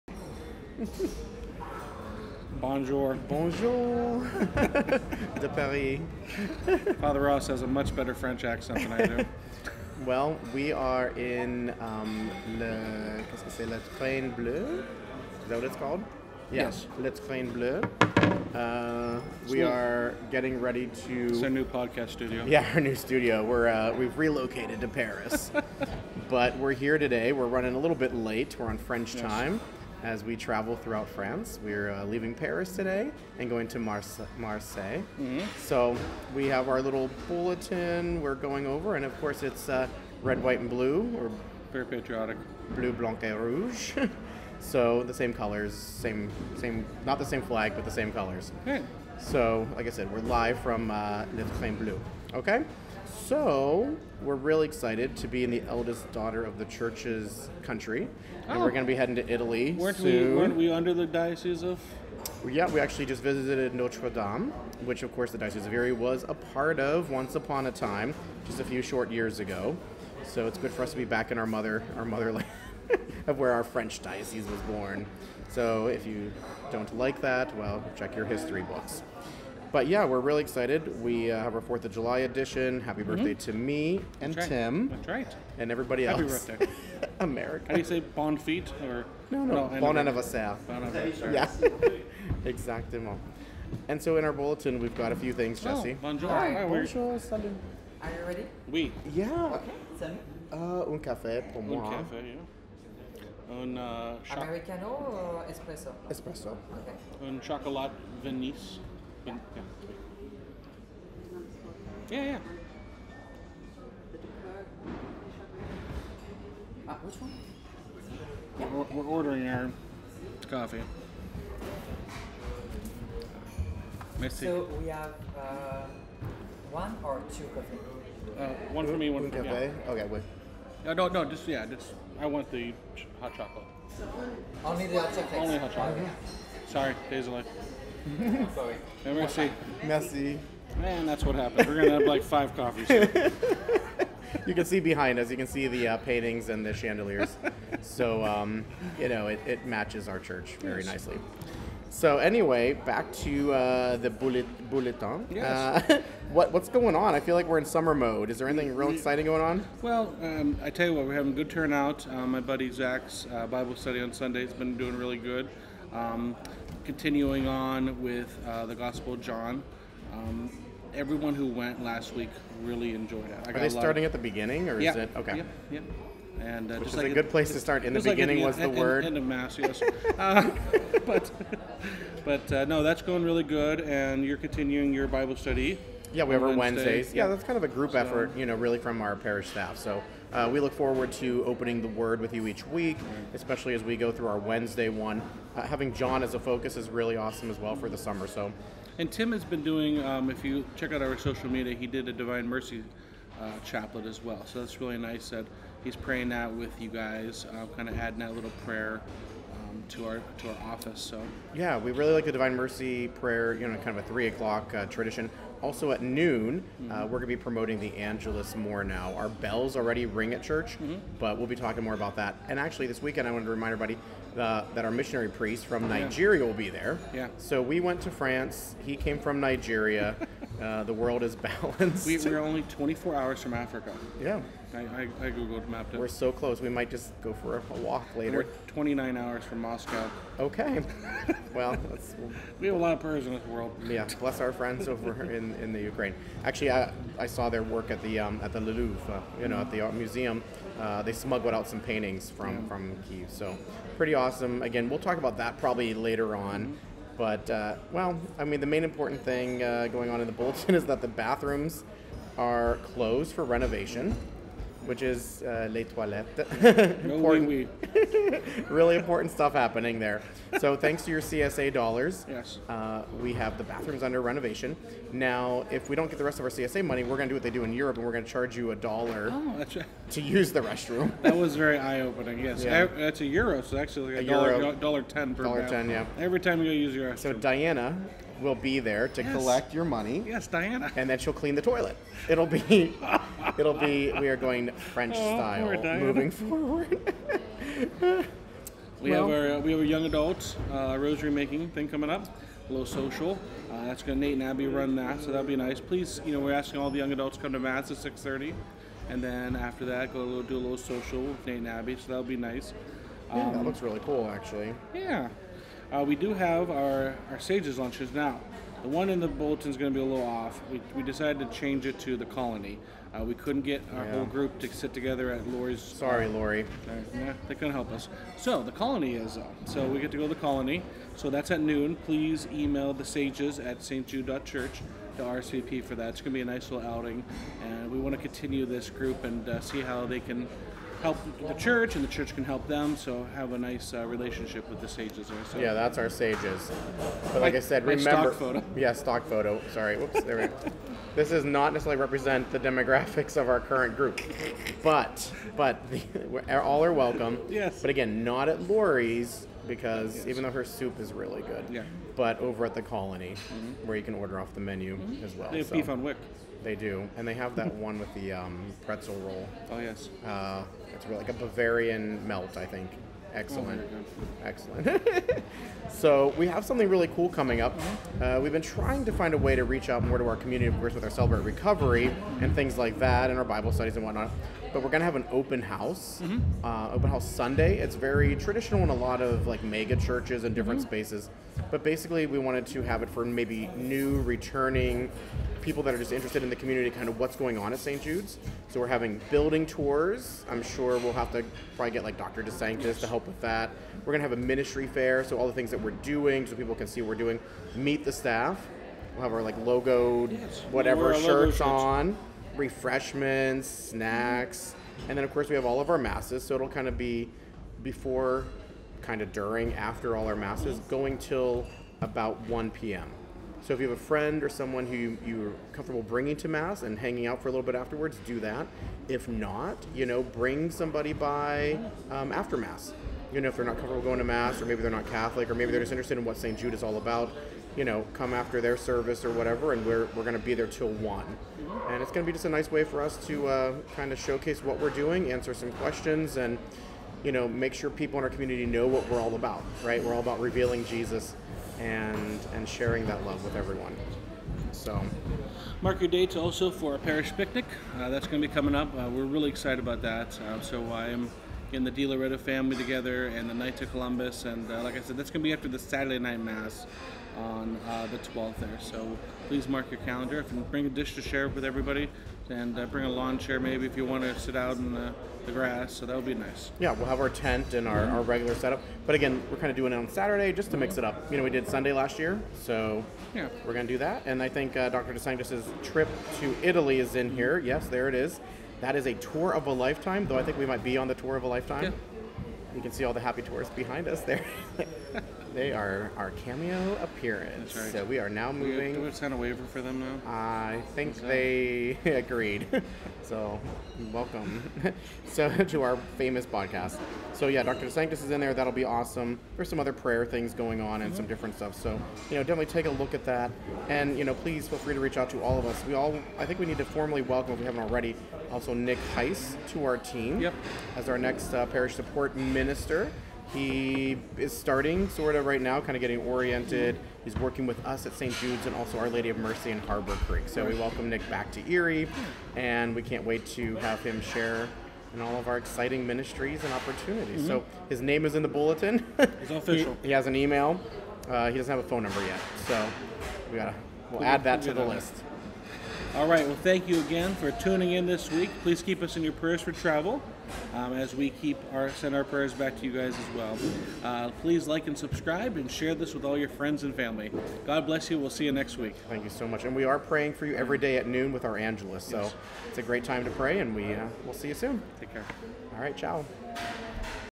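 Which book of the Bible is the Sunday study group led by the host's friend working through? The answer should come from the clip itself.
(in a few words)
Gospel of John.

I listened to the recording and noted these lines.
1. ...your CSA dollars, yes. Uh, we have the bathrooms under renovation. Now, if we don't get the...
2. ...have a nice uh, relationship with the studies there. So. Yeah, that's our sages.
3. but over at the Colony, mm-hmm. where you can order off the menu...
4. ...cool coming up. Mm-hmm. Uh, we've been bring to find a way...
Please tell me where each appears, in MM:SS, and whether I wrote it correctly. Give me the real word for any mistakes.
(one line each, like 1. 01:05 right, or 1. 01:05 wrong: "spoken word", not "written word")
1. 04:31 right
2. 05:43 wrong: "sages", not "studies"
3. 06:02 right
4. 06:17 wrong: "trying", not "bring".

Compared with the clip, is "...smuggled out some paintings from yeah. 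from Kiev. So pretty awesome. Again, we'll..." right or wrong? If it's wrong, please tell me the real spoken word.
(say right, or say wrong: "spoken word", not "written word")
right.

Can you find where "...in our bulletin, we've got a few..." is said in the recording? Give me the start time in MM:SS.
01:34.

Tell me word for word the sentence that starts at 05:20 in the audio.
We, we decided to change it to the colony.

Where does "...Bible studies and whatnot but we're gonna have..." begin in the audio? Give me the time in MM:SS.
06:23.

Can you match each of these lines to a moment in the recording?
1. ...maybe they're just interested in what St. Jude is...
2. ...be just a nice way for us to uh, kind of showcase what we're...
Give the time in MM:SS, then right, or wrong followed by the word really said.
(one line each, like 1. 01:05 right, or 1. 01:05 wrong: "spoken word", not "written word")
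1. 07:15 right
2. 07:22 right.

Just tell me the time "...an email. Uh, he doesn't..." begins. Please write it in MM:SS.
09:00.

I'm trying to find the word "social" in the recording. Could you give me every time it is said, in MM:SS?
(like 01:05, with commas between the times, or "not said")
03:21, 05:02, 05:10.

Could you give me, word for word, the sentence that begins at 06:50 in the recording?
whatever we'll logo shirts on refreshments, snacks, and then of course we have all of our masses.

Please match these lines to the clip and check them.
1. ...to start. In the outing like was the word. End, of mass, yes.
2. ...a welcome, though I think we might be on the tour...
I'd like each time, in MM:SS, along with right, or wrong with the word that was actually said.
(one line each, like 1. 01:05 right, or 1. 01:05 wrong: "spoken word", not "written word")
1. 02:57 wrong: "beginning", not "outing"
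2. 08:09 wrong: "lifetime", not "welcome".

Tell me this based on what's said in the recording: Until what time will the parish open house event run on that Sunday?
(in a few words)
1 p.m.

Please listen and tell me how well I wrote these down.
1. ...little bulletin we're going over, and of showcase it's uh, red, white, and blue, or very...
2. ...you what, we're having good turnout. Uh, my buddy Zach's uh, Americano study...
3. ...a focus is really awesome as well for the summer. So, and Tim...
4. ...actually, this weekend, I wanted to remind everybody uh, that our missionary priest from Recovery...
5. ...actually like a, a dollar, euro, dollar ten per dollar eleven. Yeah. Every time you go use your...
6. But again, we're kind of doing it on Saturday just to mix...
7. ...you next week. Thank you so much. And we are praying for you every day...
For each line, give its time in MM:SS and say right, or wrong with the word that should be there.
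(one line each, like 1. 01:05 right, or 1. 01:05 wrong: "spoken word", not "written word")
1. 00:36 wrong: "course", not "showcase"
2. 02:40 wrong: "Bible", not "Americano"
3. 03:16 right
4. 03:42 wrong: "Nigeria", not "Recovery"
5. 04:43 wrong: "ten", not "eleven"
6. 07:59 right
7. 09:18 right.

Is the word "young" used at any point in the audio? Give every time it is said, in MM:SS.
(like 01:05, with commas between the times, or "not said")
04:59, 05:06.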